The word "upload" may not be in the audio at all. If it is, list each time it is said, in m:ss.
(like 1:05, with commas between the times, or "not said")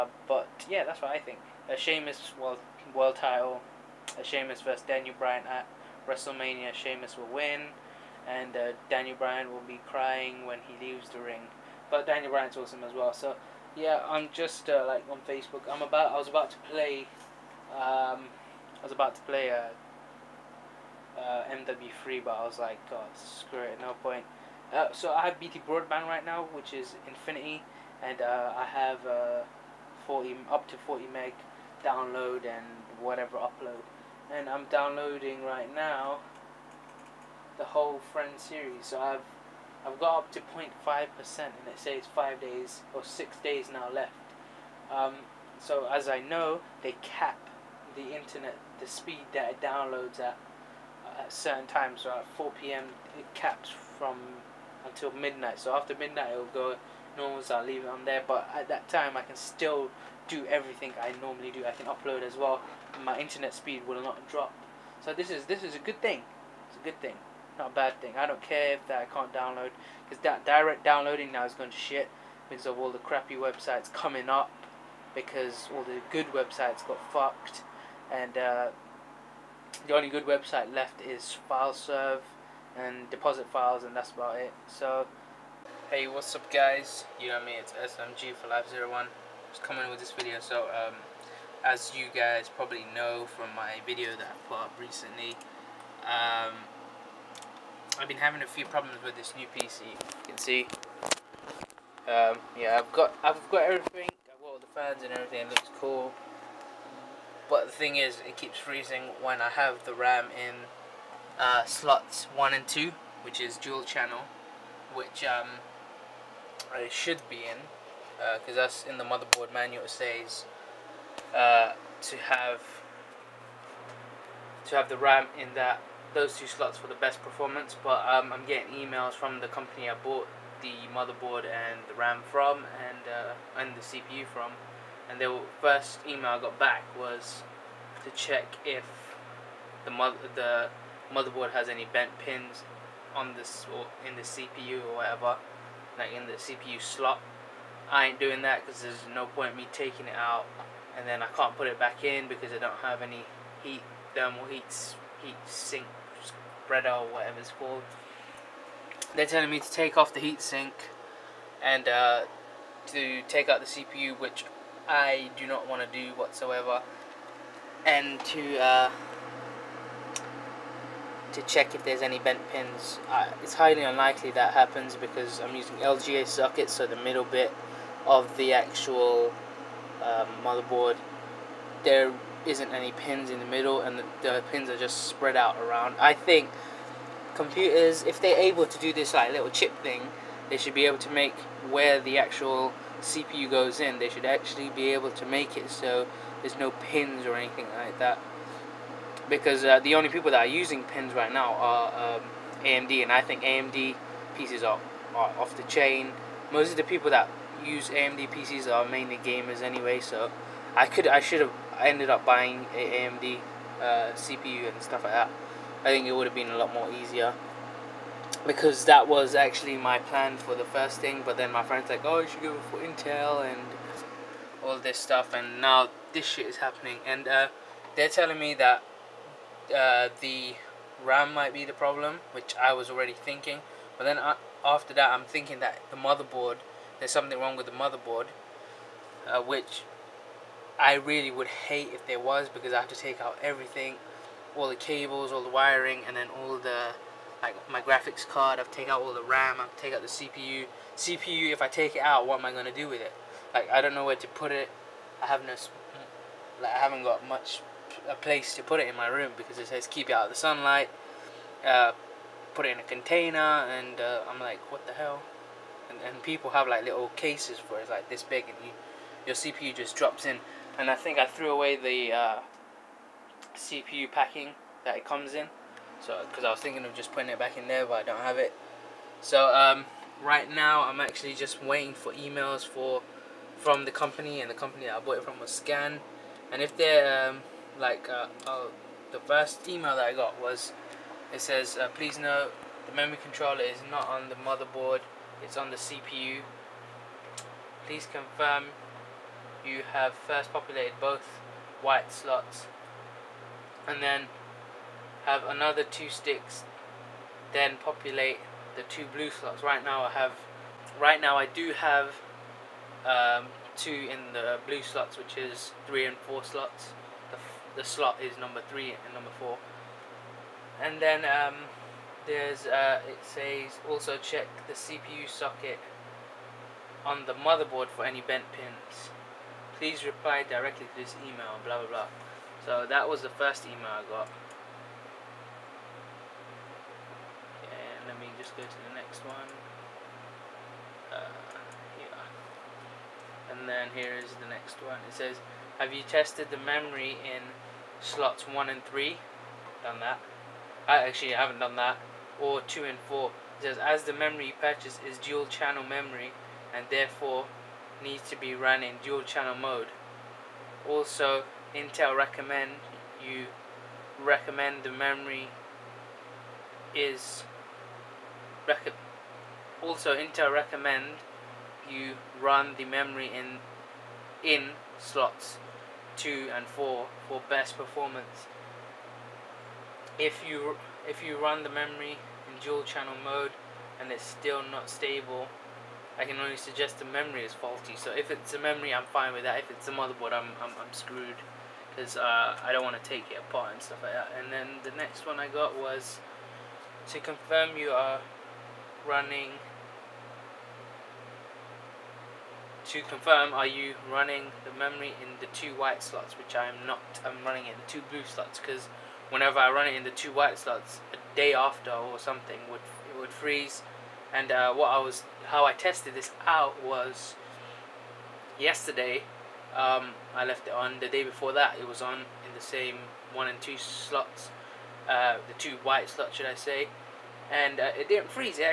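0:33, 1:01.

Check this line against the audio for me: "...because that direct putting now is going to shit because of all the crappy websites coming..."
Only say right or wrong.
wrong.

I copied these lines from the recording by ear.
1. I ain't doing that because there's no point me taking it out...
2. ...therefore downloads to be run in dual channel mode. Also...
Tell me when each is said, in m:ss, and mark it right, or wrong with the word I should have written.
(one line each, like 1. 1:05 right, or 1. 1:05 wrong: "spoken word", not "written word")
1. 2:27 right
2. 5:56 wrong: "needs", not "downloads".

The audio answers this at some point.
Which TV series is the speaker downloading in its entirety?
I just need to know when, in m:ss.
0:38.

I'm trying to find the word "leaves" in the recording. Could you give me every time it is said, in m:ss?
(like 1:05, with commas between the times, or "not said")
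0:10, 0:57.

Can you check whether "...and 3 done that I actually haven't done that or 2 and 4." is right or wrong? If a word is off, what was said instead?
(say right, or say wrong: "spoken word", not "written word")
right.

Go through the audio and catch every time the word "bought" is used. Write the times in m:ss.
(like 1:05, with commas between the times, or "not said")
2:09, 4:44.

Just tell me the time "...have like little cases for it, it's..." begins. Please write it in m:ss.
4:26.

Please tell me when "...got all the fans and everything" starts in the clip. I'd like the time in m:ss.
1:44.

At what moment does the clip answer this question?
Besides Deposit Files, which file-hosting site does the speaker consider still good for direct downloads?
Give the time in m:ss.
1:21.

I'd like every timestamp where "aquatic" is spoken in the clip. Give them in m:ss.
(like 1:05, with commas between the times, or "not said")
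not said.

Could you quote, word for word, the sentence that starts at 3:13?
They should actually be able to make it so there's no pins or anything like that.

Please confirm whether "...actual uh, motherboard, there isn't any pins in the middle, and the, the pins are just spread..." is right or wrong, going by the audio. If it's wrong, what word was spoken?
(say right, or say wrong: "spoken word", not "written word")
right.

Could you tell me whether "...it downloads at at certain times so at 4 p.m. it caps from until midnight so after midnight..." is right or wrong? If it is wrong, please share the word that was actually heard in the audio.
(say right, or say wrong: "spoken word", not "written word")
right.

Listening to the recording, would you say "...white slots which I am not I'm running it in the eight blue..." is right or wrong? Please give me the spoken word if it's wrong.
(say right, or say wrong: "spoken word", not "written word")
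wrong: "two", not "eight".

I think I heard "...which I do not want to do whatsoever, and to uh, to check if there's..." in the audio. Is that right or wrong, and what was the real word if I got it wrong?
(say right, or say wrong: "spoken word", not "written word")
right.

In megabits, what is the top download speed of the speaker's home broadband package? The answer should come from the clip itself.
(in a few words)
40.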